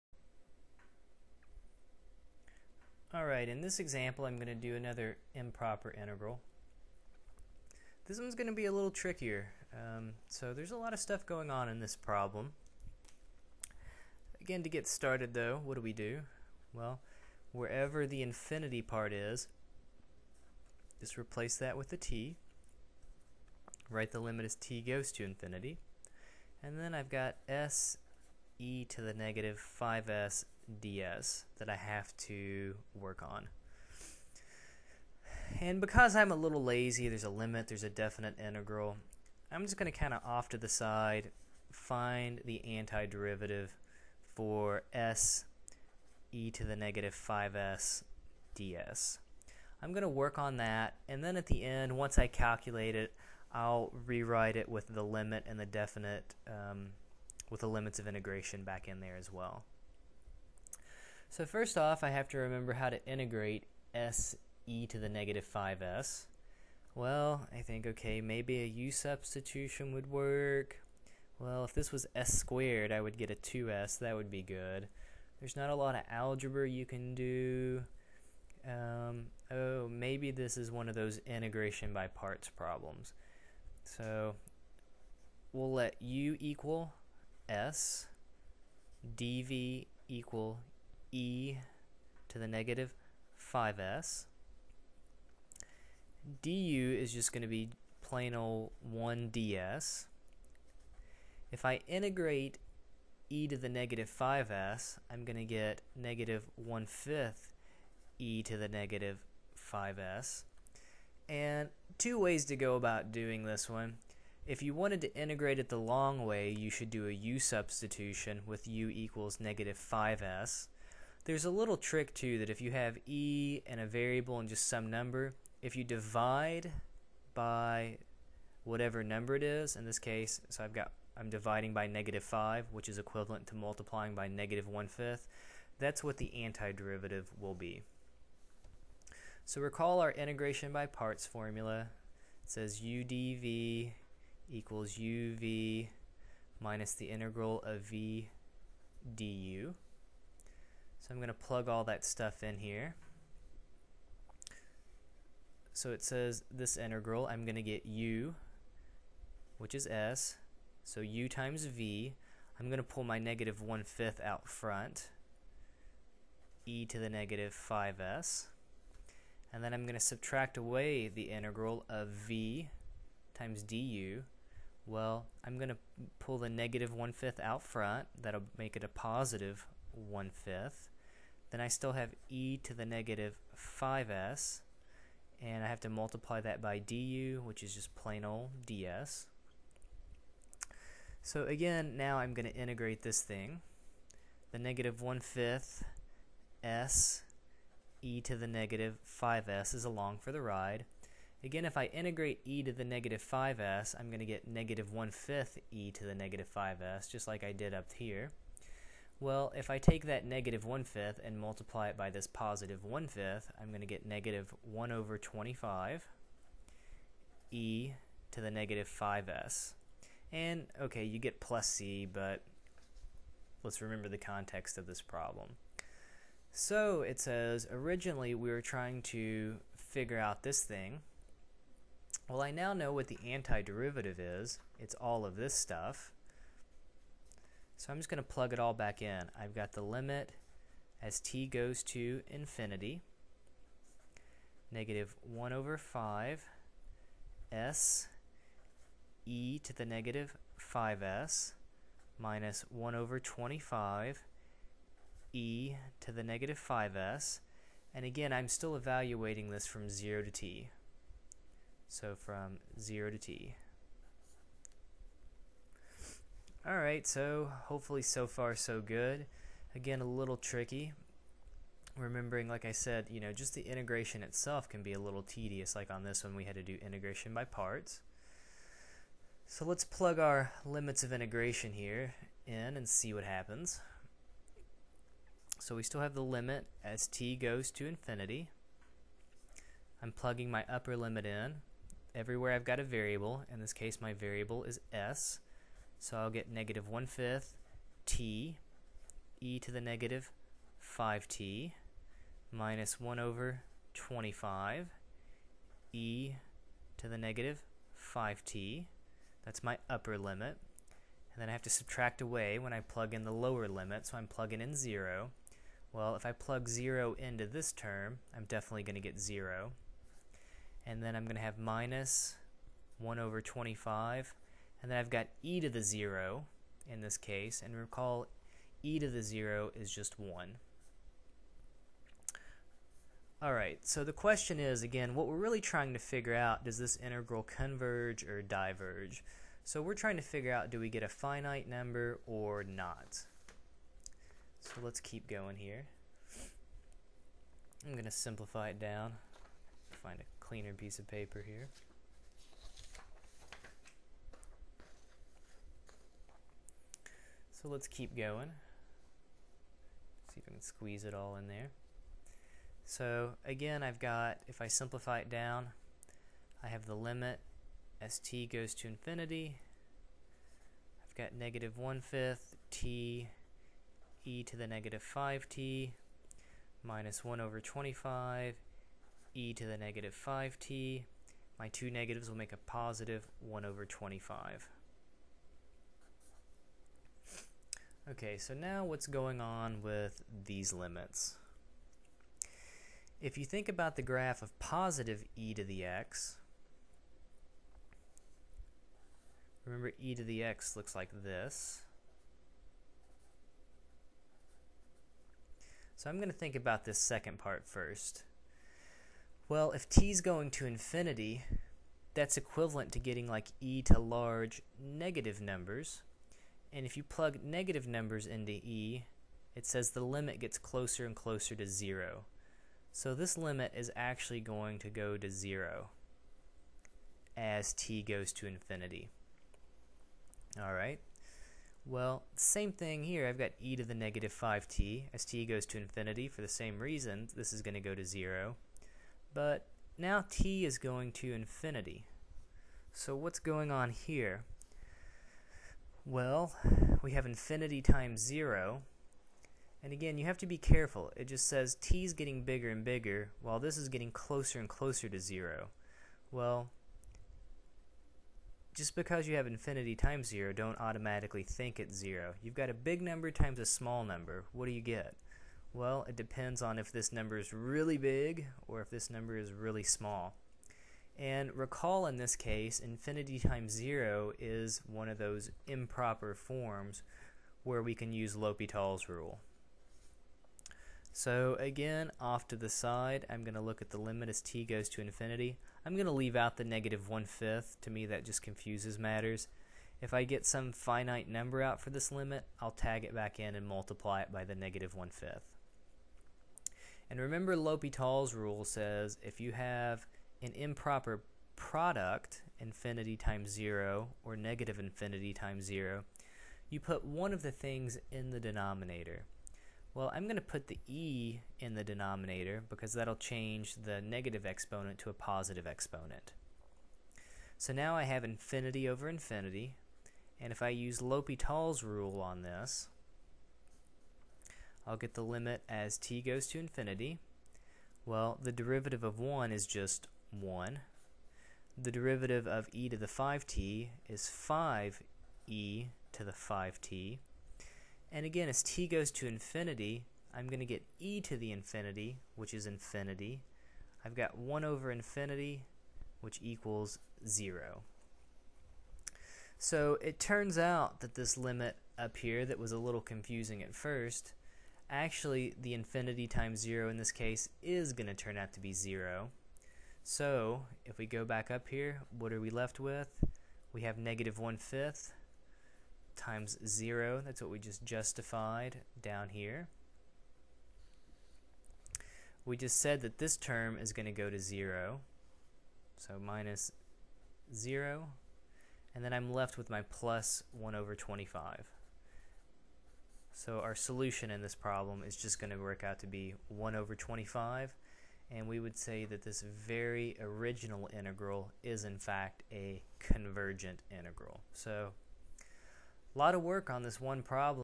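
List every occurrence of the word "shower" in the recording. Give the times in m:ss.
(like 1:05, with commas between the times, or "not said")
not said.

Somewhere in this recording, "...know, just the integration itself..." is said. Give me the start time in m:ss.
4:33.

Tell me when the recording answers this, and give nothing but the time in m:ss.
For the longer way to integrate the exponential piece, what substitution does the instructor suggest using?
1:58.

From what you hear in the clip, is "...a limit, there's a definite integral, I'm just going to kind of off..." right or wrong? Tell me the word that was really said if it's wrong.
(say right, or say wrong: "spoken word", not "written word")
right.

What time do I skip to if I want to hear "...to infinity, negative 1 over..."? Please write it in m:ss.
4:01.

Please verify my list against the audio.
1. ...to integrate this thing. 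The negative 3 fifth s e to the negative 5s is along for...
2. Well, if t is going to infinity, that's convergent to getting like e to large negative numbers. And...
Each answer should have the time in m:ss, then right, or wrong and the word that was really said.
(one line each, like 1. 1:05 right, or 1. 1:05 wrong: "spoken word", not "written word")
1. 3:12 wrong: "1", not "3"
2. 6:49 wrong: "equivalent", not "convergent".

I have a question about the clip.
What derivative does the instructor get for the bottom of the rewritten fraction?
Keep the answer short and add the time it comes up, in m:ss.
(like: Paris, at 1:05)
5e to the 5t, at 8:54.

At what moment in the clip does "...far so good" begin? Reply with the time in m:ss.
4:28.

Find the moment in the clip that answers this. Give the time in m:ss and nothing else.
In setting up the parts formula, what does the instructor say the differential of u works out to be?
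1:38.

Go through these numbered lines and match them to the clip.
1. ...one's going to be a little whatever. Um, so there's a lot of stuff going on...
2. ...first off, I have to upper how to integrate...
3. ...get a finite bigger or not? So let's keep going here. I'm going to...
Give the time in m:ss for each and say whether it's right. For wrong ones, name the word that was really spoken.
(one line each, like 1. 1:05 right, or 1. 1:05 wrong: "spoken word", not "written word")
1. 0:08 wrong: "trickier", not "whatever"
2. 1:01 wrong: "remember", not "upper"
3. 5:40 wrong: "number", not "bigger".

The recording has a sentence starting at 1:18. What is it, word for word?
Um, oh, maybe this is one of those integration by parts problems.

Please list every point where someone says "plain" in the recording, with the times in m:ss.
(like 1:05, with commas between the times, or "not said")
1:38, 3:07.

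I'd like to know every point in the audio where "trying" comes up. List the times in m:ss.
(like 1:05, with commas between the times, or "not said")
3:48, 5:35, 5:39.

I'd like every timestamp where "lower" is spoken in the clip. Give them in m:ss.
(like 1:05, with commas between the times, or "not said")
5:13.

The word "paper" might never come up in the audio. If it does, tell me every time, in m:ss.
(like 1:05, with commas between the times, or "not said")
5:51.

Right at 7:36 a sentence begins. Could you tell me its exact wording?
Well, just because you have infinity times 0, don't automatically think it's 0.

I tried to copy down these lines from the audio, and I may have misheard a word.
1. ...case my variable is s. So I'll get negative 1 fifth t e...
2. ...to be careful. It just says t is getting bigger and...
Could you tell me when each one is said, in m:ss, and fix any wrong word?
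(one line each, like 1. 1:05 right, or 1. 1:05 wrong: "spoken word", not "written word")
1. 4:53 right
2. 7:30 right.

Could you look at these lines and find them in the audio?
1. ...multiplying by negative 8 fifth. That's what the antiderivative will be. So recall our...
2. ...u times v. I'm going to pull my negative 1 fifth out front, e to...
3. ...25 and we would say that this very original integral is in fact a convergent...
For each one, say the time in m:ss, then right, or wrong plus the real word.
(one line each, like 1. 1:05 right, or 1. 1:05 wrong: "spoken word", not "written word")
1. 2:13 wrong: "1", not "8"
2. 2:41 right
3. 9:46 right.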